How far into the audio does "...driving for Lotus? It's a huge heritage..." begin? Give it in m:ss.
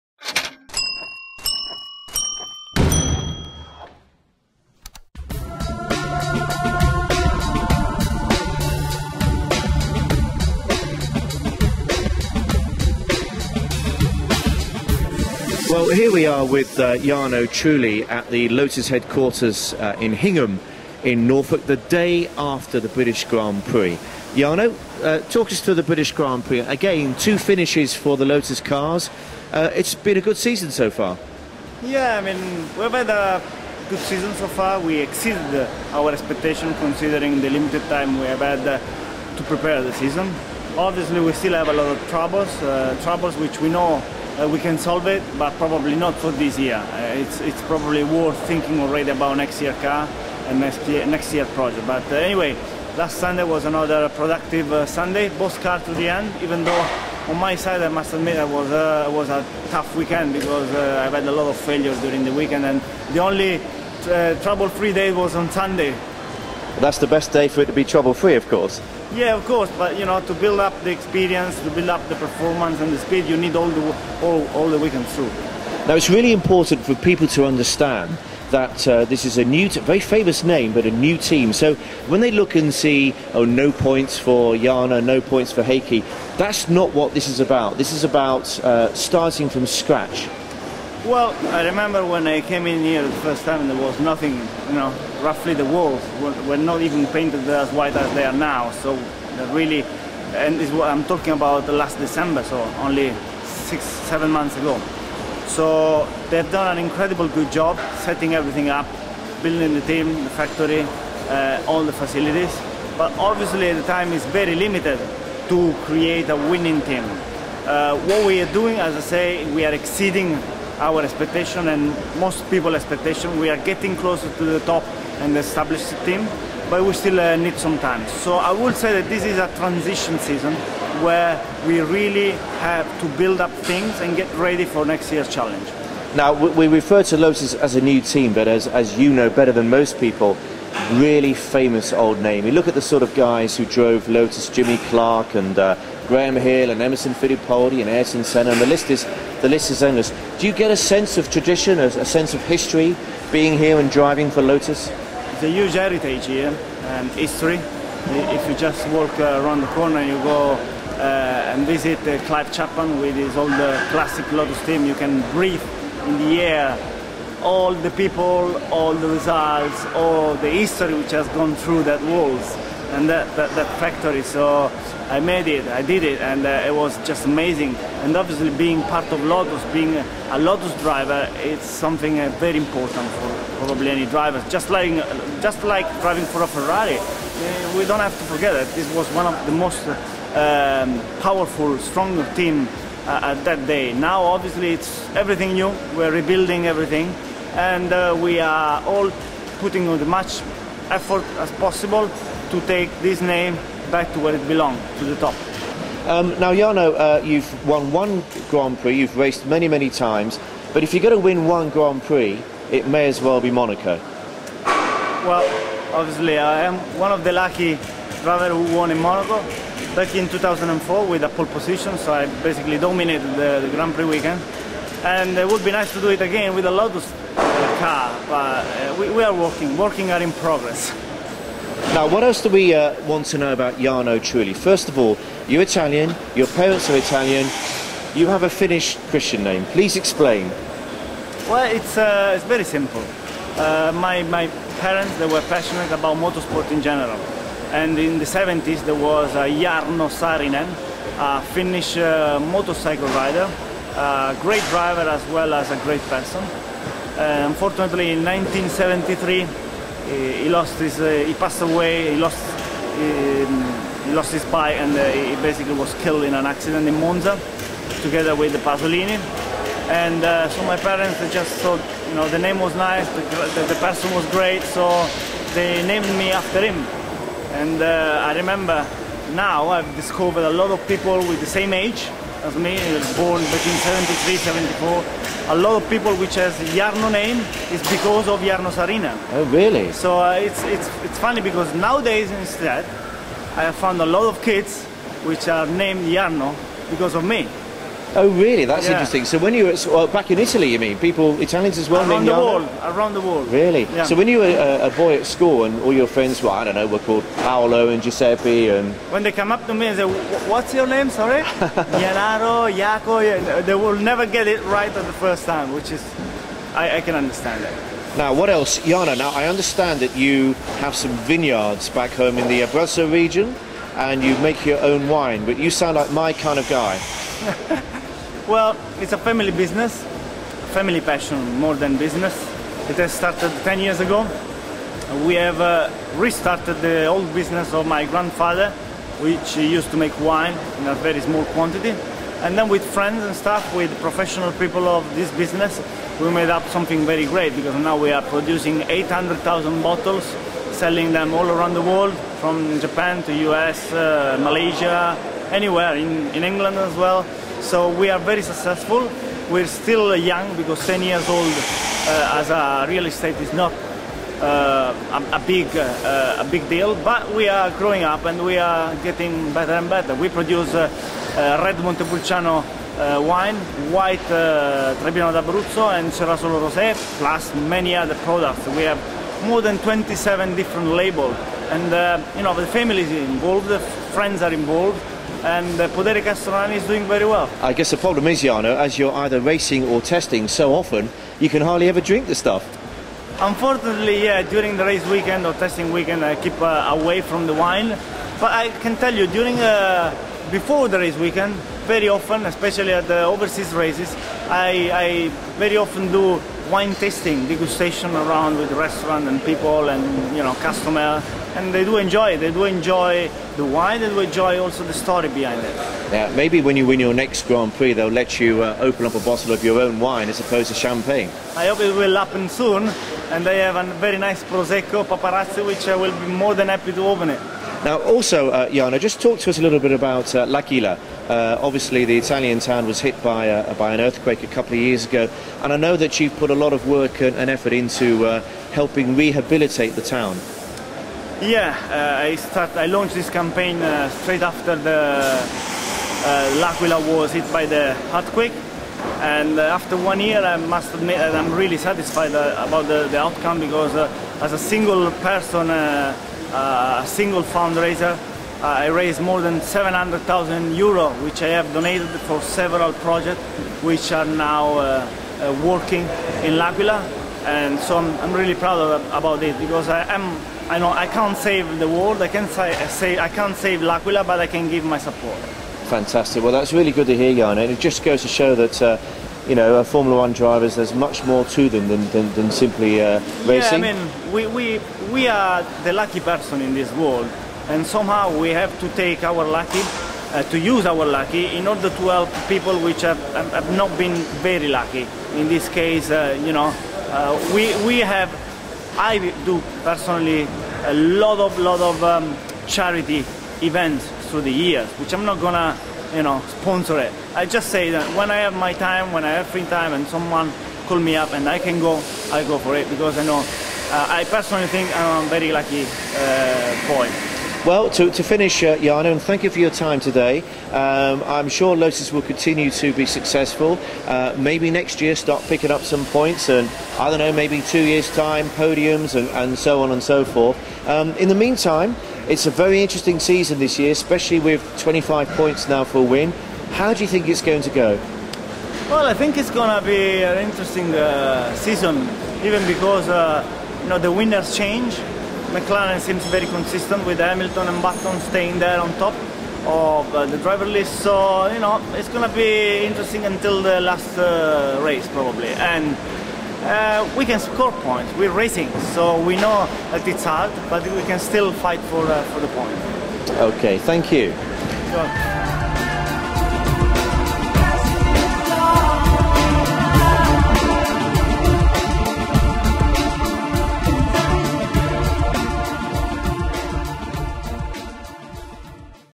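2:33.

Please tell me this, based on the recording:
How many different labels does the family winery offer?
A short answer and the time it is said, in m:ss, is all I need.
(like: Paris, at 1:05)
27, at 6:19.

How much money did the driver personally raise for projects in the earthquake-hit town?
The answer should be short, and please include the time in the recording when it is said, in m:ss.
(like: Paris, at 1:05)
700,000 euro, at 7:39.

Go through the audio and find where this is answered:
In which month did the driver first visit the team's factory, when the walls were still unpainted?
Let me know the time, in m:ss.
1:41.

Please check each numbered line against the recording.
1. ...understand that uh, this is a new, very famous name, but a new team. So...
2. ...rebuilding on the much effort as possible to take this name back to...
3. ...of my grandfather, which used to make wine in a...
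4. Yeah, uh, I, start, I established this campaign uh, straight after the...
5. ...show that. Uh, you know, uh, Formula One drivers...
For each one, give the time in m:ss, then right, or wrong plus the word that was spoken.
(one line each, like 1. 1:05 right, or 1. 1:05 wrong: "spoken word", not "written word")
1. 1:17 right
2. 3:19 wrong: "putting", not "rebuilding"
3. 5:37 right
4. 7:21 wrong: "launched", not "established"
5. 7:58 right.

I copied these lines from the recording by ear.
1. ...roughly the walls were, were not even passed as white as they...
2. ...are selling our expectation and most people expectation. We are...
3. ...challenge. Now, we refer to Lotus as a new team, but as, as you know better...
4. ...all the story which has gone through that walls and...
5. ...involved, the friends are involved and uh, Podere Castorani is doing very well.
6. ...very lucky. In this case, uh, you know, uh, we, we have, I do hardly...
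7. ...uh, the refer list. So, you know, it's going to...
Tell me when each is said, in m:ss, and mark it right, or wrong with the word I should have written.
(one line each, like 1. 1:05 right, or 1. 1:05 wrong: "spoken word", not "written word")
1. 1:35 wrong: "painted", not "passed"
2. 1:59 wrong: "exceeding", not "selling"
3. 2:15 right
4. 2:49 wrong: "history", not "story"
5. 6:23 right
6. 8:14 wrong: "personally", not "hardly"
7. 9:10 wrong: "driver", not "refer".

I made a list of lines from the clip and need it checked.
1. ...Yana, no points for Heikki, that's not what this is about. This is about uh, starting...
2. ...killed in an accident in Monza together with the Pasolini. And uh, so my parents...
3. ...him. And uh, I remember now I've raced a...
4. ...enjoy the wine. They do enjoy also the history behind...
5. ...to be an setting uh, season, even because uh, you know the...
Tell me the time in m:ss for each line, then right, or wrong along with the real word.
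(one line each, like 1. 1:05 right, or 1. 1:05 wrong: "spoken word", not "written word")
1. 1:24 right
2. 4:25 right
3. 4:36 wrong: "discovered", not "raced"
4. 6:52 wrong: "story", not "history"
5. 8:59 wrong: "interesting", not "setting".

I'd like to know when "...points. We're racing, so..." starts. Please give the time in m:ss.
9:17.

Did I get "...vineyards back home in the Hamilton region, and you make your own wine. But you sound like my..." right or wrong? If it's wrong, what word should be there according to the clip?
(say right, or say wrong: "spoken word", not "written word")
wrong: "Abruzzo", not "Hamilton".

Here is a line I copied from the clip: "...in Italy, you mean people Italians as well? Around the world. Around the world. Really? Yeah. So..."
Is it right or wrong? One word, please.
right.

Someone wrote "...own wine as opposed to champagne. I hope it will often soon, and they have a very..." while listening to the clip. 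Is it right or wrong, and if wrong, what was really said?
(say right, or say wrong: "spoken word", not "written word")
wrong: "happen", not "often".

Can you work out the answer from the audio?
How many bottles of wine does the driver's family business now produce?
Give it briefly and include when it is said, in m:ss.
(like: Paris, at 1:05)
800,000, at 5:48.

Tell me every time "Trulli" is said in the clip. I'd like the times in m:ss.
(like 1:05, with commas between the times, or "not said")
0:17, 3:54.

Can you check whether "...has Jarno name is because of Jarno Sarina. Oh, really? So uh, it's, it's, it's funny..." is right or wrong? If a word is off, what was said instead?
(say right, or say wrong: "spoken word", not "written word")
right.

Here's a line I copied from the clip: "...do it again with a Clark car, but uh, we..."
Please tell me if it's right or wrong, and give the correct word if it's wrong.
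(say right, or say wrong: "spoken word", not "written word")
wrong: "Lotus", not "Clark".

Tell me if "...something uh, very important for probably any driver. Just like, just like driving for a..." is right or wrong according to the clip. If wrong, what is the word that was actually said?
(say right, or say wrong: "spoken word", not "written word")
right.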